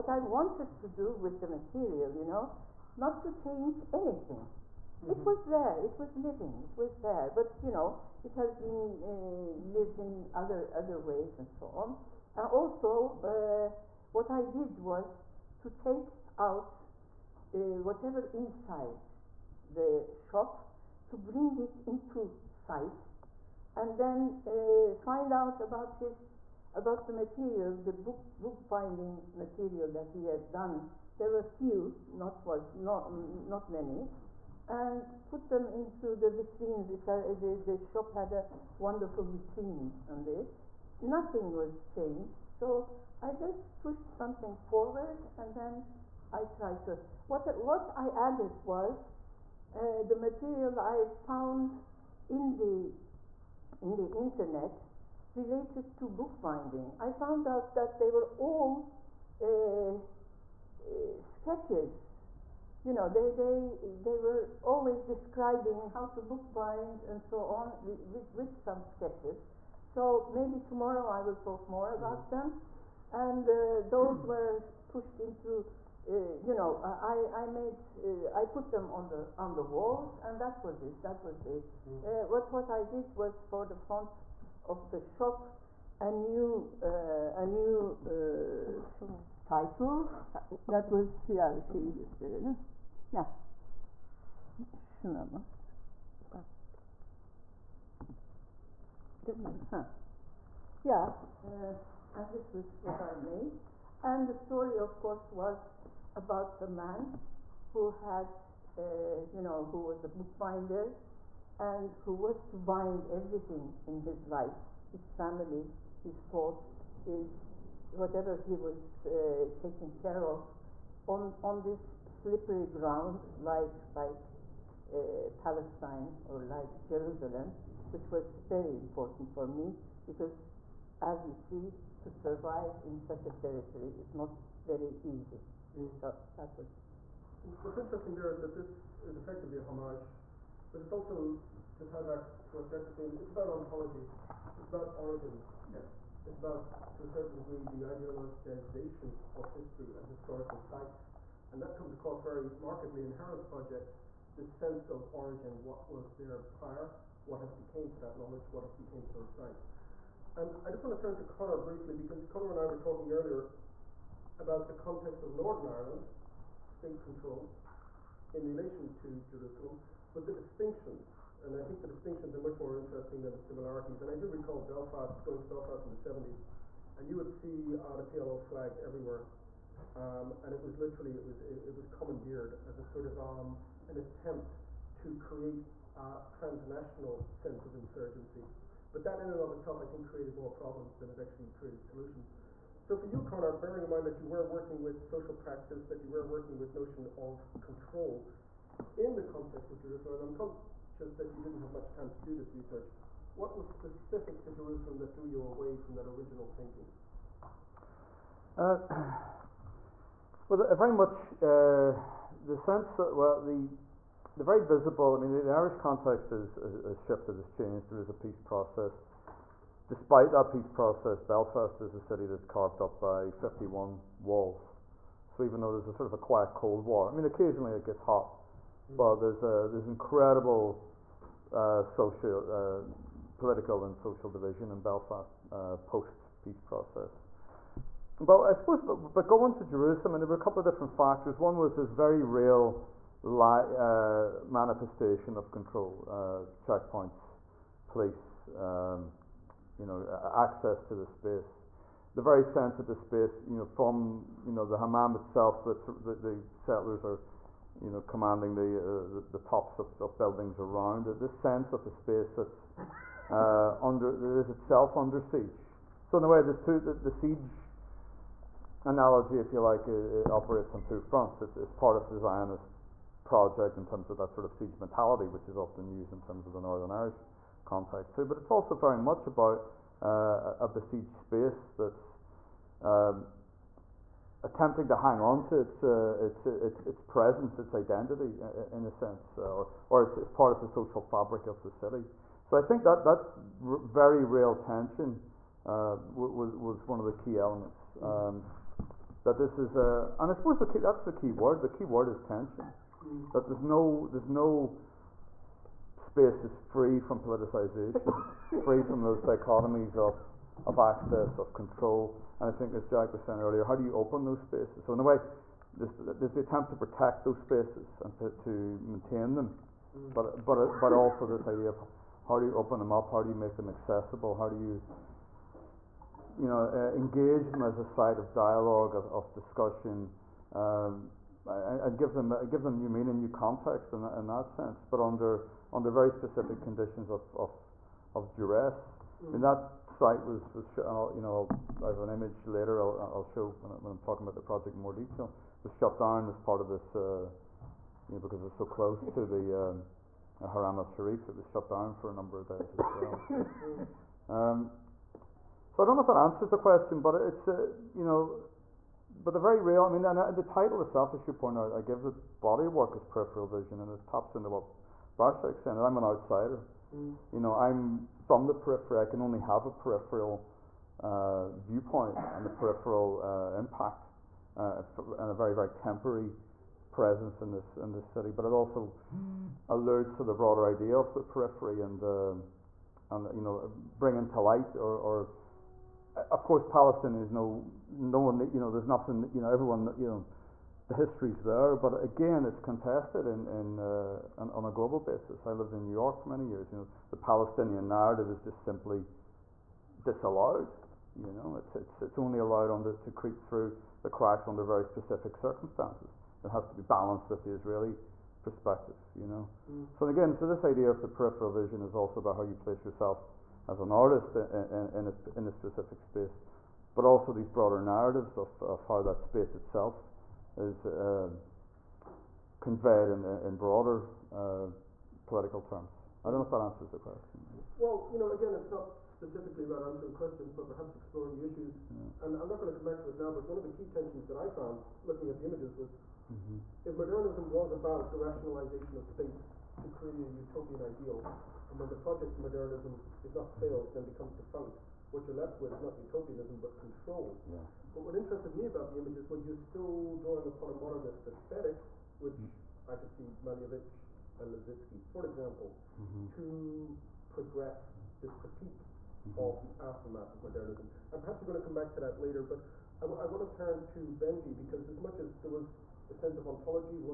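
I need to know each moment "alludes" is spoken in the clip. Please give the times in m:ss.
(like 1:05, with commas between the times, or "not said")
6:19.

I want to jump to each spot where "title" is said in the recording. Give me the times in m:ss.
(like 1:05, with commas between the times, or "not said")
1:29, 6:00.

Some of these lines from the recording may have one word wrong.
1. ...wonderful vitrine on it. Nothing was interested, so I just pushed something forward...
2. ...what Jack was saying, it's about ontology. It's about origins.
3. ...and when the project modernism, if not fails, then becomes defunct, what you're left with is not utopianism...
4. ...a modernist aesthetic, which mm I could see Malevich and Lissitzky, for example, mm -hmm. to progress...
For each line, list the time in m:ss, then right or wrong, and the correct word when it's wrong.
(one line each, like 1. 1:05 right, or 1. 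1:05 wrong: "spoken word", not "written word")
1. 0:38 wrong: "changed", not "interested"
2. 2:22 right
3. 7:21 right
4. 7:30 right.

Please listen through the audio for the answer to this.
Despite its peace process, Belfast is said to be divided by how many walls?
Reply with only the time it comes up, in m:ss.
3:43.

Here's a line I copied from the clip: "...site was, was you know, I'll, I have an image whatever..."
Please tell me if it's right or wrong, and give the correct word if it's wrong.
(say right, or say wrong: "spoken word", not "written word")
wrong: "later", not "whatever".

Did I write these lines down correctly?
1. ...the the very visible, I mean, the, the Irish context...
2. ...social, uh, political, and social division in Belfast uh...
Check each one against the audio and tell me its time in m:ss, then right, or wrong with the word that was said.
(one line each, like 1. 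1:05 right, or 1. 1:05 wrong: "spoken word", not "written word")
1. 3:33 right
2. 3:51 right.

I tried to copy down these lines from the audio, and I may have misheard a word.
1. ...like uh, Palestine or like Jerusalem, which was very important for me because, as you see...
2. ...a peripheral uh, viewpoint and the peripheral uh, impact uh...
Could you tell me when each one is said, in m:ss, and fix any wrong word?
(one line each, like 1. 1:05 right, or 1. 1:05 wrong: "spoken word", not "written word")
1. 2:03 right
2. 6:09 right.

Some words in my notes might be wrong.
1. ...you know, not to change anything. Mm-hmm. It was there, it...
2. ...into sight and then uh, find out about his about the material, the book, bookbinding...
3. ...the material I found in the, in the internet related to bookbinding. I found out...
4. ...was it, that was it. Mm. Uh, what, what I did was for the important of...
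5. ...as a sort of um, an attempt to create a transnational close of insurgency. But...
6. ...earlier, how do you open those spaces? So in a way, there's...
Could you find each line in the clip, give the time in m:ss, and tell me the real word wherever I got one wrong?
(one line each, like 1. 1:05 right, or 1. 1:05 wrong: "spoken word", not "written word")
1. 0:02 right
2. 0:21 right
3. 0:50 right
4. 1:20 wrong: "front", not "important"
5. 3:02 wrong: "sense", not "close"
6. 5:13 right.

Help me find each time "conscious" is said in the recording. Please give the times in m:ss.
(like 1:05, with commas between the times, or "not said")
3:20.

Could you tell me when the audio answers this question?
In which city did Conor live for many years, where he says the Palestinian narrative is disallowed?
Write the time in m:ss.
6:35.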